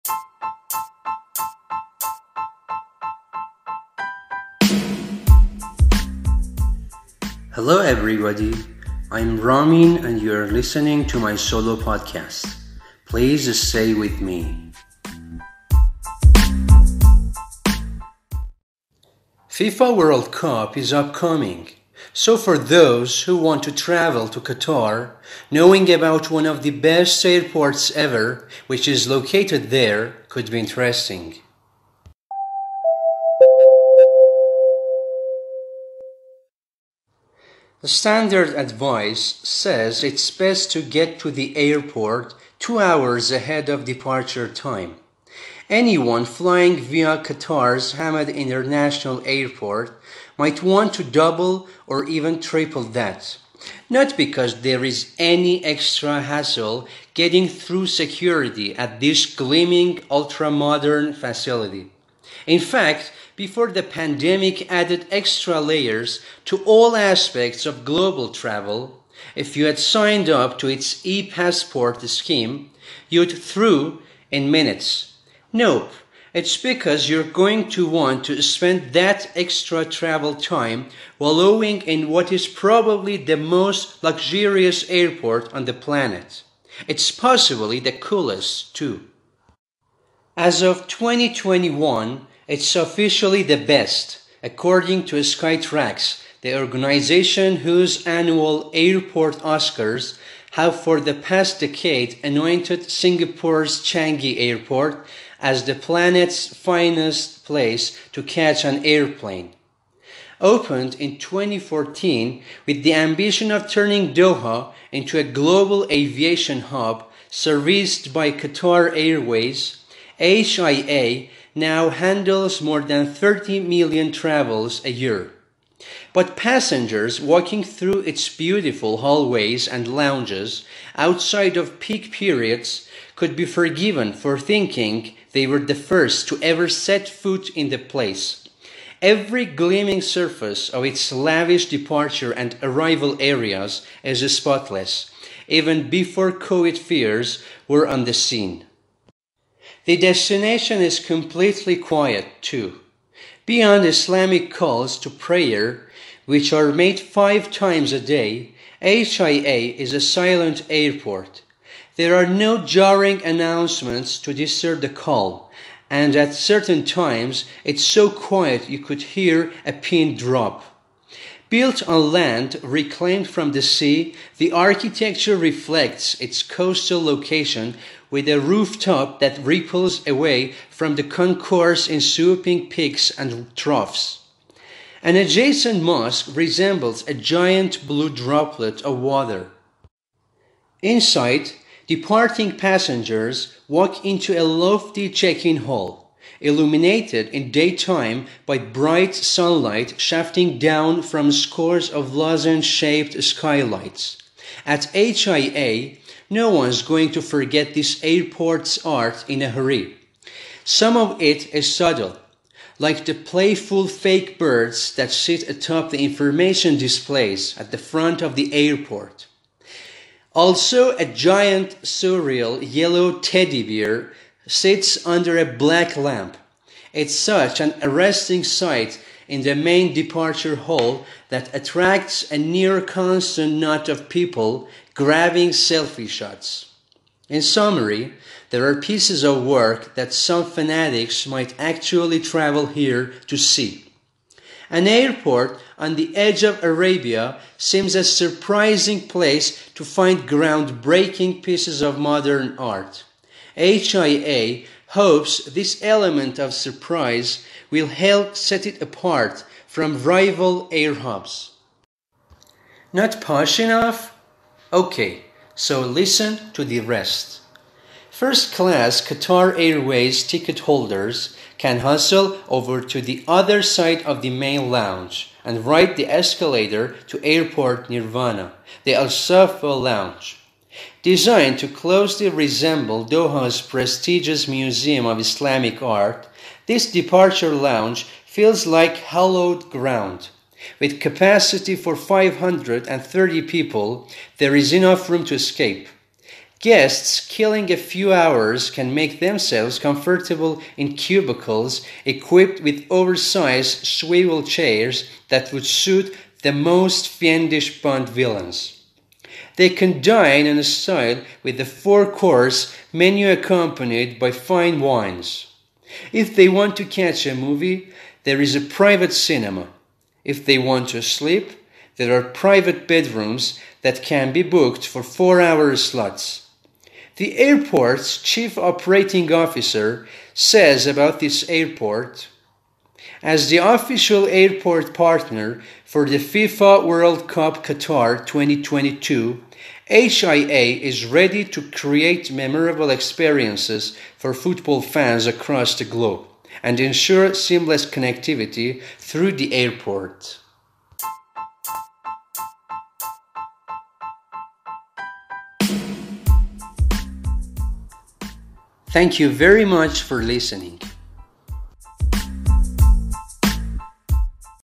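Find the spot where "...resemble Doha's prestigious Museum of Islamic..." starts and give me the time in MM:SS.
04:42.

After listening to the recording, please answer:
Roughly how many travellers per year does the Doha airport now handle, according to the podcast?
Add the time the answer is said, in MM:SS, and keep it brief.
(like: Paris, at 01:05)
30 million, at 02:03.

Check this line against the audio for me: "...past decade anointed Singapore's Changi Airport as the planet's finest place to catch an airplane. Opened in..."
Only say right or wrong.
right.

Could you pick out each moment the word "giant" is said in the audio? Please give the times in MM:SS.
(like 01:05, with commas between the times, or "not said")
03:07, 03:41.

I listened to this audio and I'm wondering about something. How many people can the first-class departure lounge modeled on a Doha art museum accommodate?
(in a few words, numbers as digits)
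530.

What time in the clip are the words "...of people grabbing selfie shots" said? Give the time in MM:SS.
03:53.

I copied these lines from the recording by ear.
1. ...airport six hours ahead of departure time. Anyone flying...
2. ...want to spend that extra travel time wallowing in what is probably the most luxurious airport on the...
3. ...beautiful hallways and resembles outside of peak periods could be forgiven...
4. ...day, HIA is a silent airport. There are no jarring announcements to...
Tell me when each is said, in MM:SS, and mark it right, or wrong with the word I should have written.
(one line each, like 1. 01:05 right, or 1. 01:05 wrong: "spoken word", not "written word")
1. 00:41 wrong: "two", not "six"
2. 01:17 right
3. 02:08 wrong: "lounges", not "resembles"
4. 02:37 right.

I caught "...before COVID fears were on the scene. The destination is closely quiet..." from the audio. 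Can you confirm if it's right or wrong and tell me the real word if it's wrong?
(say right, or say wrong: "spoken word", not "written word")
wrong: "completely", not "closely".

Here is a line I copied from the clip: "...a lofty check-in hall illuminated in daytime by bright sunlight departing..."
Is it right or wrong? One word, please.
wrong.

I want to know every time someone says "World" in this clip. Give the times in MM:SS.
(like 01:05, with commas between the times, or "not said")
00:19, 05:36.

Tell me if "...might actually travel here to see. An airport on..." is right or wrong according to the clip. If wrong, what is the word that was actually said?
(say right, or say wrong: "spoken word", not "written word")
right.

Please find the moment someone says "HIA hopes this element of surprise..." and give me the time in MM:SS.
04:13.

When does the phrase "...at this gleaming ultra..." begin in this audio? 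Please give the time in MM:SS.
00:58.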